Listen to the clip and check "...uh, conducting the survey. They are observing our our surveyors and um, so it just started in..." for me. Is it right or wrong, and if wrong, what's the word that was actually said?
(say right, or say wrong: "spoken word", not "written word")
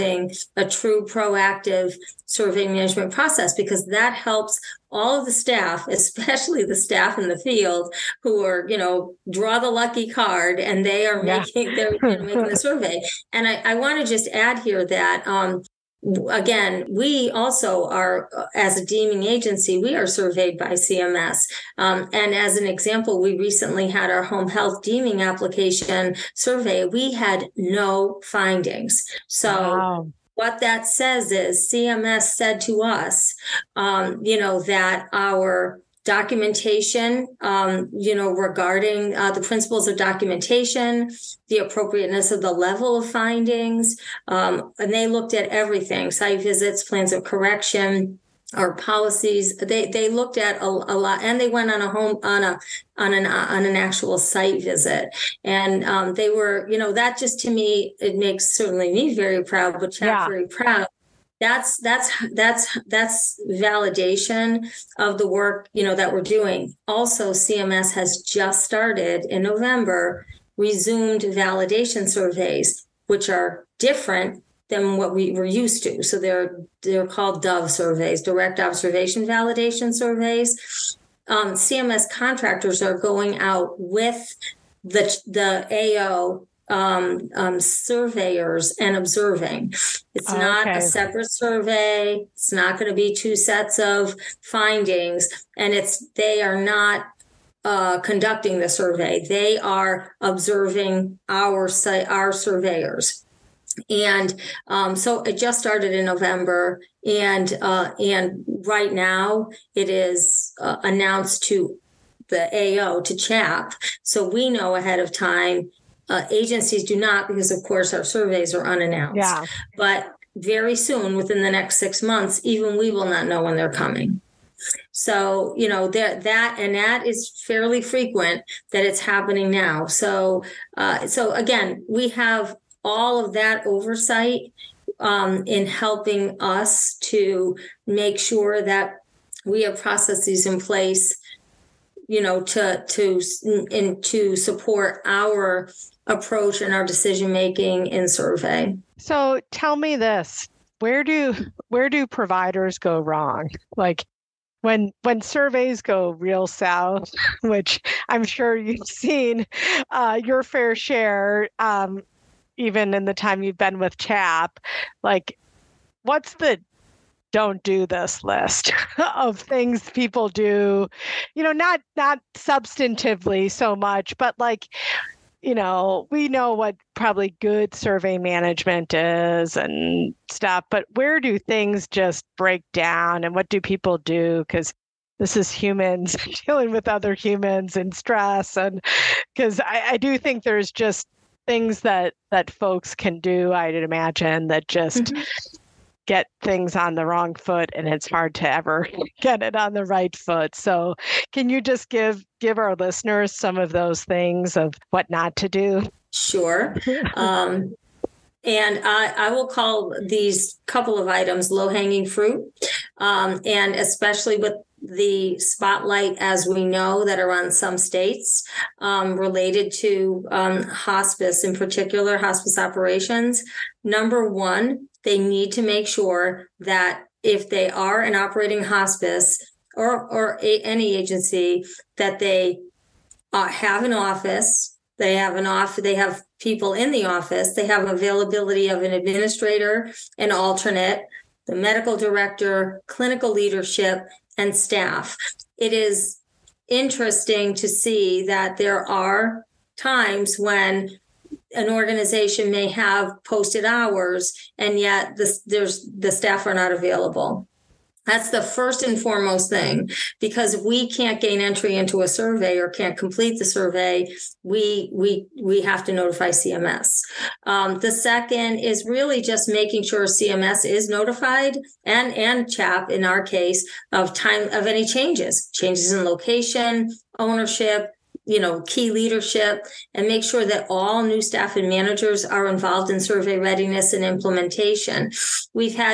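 right.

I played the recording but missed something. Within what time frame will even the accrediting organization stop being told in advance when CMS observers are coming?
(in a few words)
6 months.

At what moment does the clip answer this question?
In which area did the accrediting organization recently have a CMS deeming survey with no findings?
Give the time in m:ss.
0:24.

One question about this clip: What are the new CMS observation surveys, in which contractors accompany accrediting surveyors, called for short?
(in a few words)
Dove surveys.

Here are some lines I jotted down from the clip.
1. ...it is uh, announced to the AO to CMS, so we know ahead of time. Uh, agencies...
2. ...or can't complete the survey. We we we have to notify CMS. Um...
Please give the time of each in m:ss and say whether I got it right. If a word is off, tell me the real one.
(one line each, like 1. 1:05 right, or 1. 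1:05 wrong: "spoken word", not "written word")
1. 1:49 wrong: "CHAP", not "CMS"
2. 4:22 right.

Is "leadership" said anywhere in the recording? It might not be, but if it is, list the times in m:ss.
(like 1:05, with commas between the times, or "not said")
4:03, 4:38.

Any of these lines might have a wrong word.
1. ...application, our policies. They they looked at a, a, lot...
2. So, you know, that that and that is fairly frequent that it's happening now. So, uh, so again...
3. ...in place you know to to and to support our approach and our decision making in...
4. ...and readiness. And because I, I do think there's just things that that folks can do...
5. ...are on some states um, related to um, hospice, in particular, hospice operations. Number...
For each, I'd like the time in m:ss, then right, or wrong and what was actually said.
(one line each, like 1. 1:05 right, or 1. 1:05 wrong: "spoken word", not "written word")
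1. 0:47 wrong: "correction", not "application"
2. 2:04 right
3. 2:20 right
4. 3:07 wrong: "stress", not "readiness"
5. 3:37 right.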